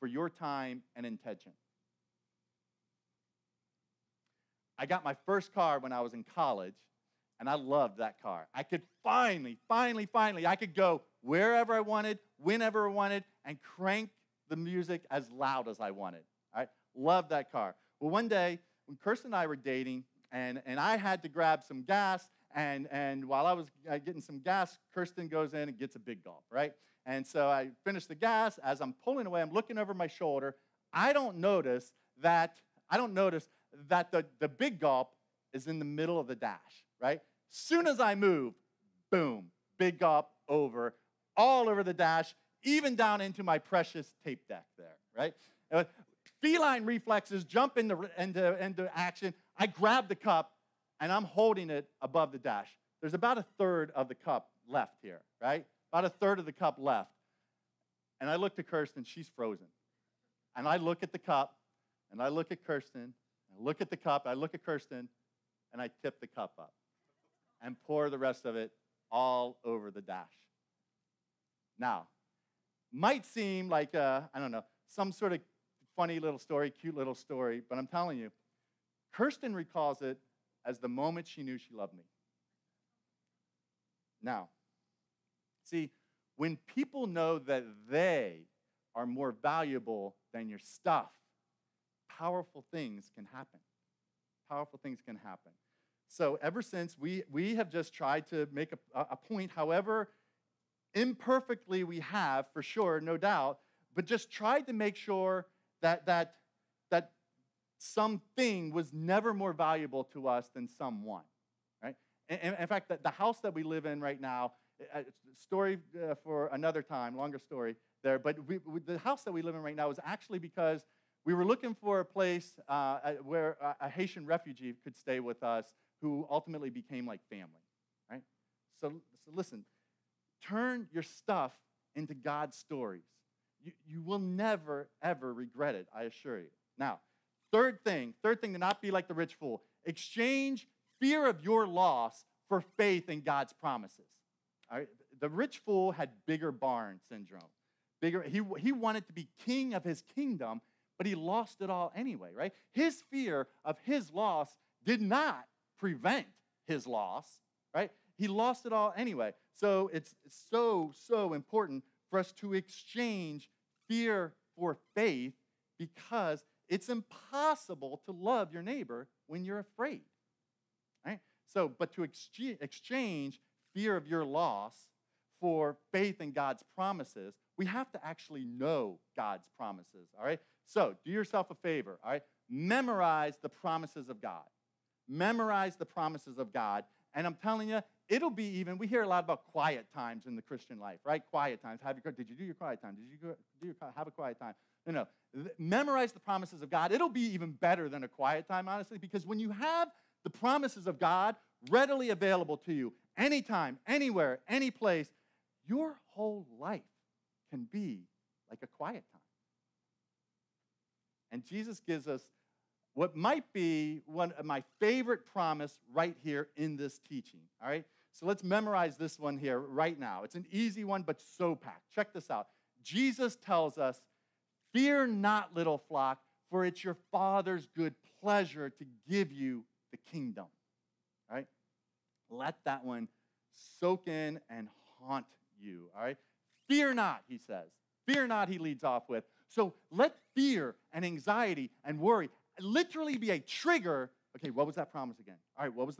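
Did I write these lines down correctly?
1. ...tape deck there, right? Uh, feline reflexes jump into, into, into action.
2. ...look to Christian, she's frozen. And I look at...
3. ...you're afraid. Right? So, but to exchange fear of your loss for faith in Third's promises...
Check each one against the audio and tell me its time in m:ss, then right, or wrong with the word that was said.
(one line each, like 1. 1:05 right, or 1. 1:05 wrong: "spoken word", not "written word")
1. 0:44 right
2. 0:58 wrong: "Kirsten", not "Christian"
3. 2:49 wrong: "God", not "Third".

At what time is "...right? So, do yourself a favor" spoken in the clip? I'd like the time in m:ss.
3:00.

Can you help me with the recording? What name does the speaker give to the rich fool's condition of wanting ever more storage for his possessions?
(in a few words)
bigger barn syndrome.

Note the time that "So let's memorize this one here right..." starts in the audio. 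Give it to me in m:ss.
3:38.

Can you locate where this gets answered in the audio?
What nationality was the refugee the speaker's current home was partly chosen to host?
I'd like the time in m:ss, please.
2:03.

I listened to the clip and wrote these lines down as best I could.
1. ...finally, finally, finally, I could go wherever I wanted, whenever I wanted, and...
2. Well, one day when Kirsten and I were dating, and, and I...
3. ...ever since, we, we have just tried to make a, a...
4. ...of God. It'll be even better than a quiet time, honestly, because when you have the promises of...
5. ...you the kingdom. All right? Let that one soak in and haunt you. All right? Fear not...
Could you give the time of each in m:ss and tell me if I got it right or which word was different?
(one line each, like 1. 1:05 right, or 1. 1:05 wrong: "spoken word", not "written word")
1. 0:09 right
2. 0:17 right
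3. 1:36 right
4. 3:16 right
5. 3:49 right.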